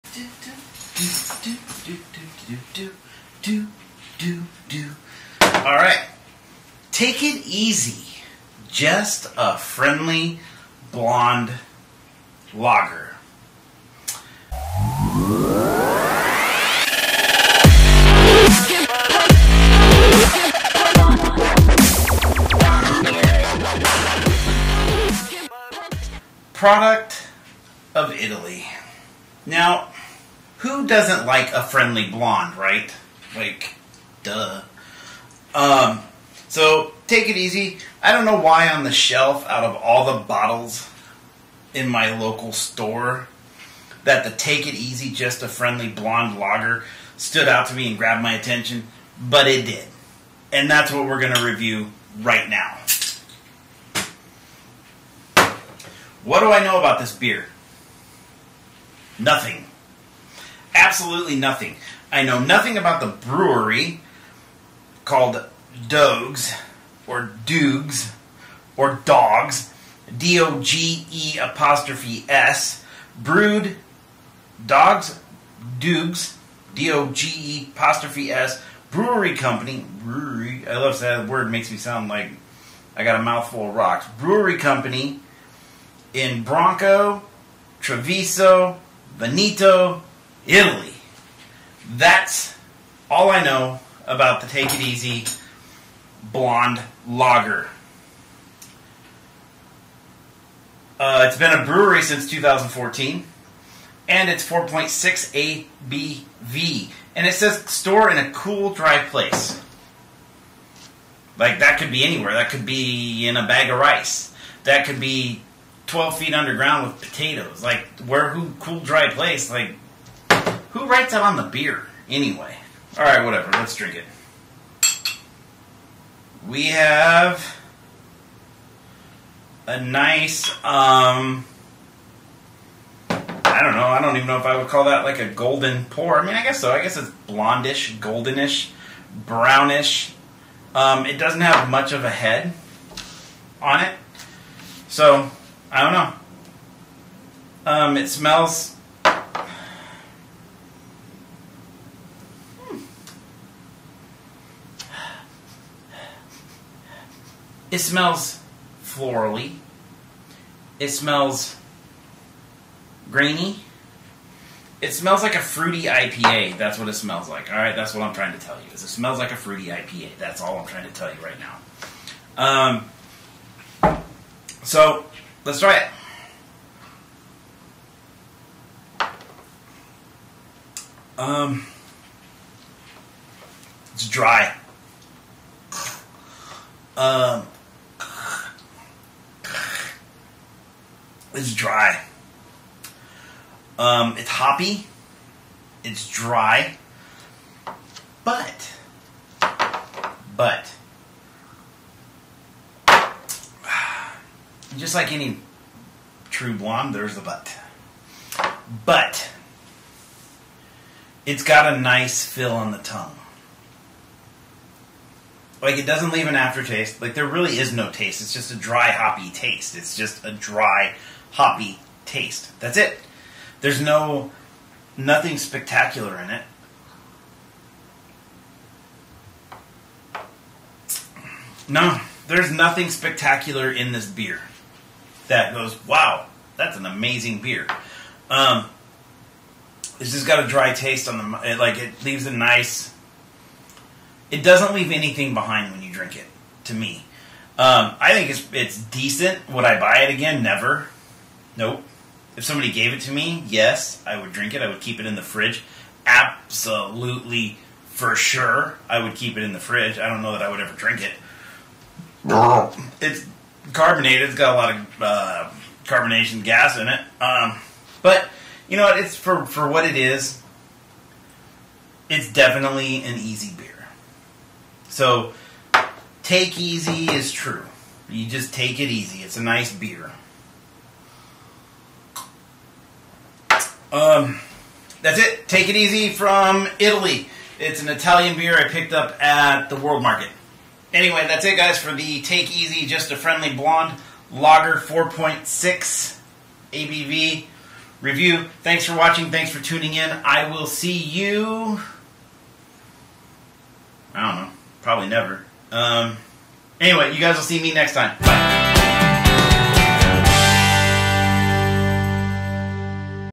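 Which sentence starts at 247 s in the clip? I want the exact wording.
Um, I think it's, it's decent.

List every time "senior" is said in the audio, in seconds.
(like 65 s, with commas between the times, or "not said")
not said.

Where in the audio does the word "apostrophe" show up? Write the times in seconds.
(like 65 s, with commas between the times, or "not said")
71 s, 77 s.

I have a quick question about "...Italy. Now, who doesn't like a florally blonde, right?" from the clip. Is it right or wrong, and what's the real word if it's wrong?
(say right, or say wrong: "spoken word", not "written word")
wrong: "friendly", not "florally".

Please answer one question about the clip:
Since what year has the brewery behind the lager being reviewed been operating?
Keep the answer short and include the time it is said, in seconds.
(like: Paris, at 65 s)
2014, at 102 s.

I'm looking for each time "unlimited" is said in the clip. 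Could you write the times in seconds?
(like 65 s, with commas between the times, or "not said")
not said.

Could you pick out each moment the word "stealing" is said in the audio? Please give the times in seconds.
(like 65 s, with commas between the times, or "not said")
not said.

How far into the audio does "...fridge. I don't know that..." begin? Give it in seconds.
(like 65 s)
259 s.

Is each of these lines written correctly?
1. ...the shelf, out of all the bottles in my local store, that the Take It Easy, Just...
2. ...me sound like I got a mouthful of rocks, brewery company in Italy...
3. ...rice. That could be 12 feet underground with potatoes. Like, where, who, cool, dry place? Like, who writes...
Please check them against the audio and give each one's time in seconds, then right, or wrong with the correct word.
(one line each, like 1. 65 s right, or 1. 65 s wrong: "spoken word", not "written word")
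1. 38 s right
2. 81 s wrong: "Bronco", not "Italy"
3. 113 s right.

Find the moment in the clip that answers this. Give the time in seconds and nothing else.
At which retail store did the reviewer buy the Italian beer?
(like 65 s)
289 s.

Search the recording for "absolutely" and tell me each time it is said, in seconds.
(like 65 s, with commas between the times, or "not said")
60 s, 256 s.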